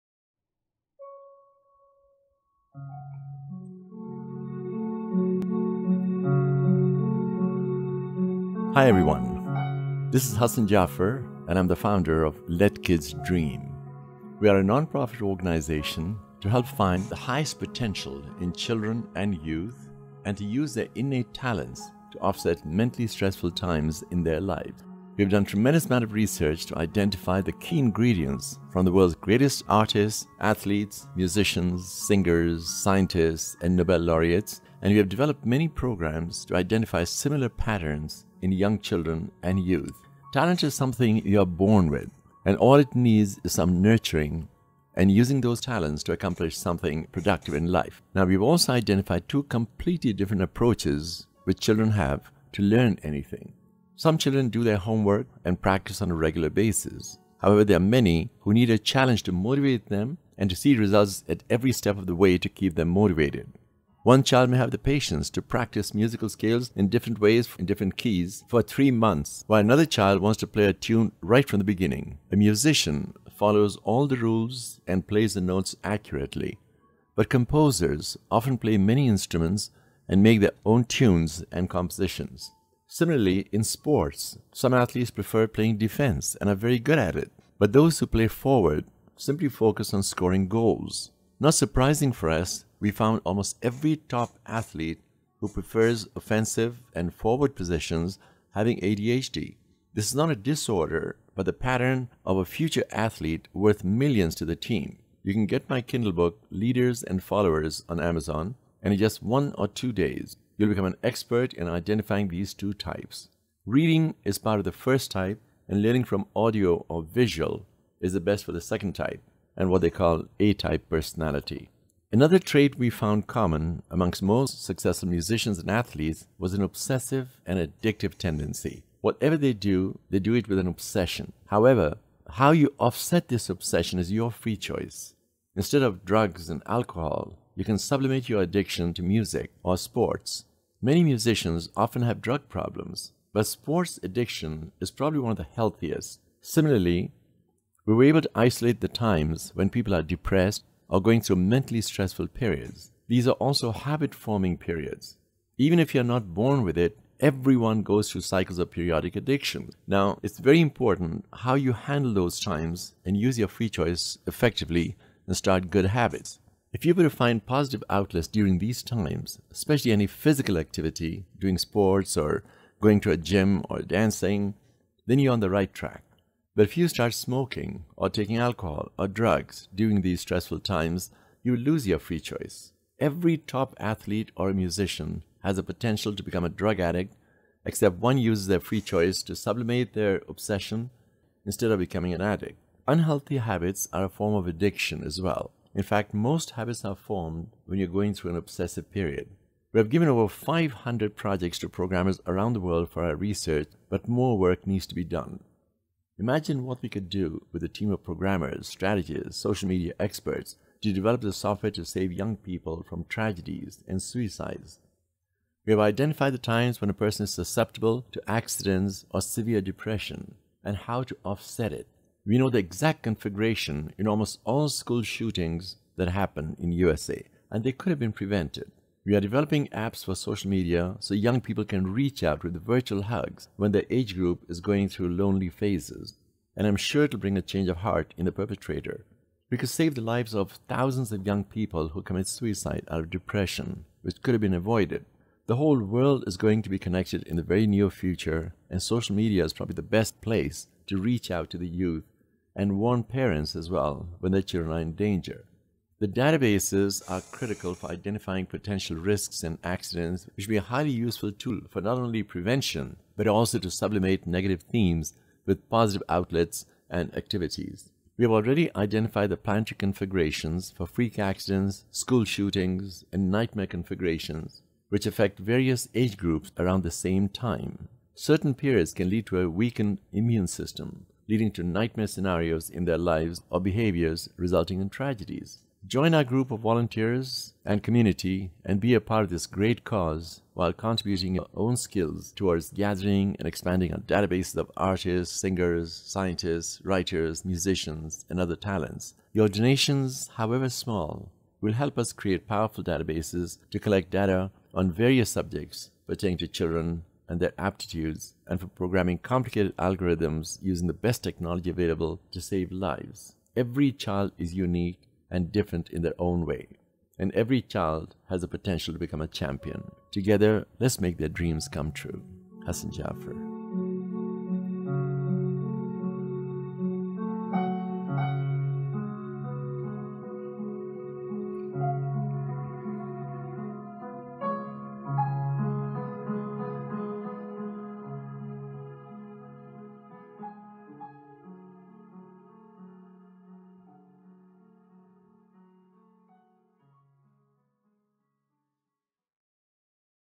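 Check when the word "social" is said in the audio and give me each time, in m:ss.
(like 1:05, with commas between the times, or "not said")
3:29, 3:50, 4:08.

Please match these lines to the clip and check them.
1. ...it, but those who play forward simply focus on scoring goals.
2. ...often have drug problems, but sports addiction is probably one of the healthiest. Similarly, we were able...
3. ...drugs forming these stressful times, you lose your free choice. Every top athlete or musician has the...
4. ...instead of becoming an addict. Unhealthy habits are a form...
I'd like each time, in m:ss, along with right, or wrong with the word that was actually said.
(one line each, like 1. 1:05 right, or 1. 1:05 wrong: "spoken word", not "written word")
1. 1:27 right
2. 2:21 right
3. 2:59 wrong: "during", not "forming"
4. 3:11 right.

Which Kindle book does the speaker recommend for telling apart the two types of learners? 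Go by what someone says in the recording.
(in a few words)
Leaders and Followers.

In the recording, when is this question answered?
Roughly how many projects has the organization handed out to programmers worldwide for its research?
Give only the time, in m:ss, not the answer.
3:20.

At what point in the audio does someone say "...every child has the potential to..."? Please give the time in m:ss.
5:17.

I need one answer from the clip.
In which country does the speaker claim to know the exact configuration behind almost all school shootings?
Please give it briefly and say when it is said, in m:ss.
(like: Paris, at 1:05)
USA, at 3:46.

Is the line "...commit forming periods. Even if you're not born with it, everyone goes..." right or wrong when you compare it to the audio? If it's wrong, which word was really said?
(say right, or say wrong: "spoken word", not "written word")
wrong: "habit", not "commit".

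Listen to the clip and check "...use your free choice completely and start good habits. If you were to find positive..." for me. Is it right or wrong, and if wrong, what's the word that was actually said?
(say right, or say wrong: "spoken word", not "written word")
wrong: "effectively", not "completely".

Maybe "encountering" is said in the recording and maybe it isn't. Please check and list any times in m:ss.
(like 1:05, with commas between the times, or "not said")
not said.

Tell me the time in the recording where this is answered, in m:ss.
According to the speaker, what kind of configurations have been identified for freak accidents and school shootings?
4:29.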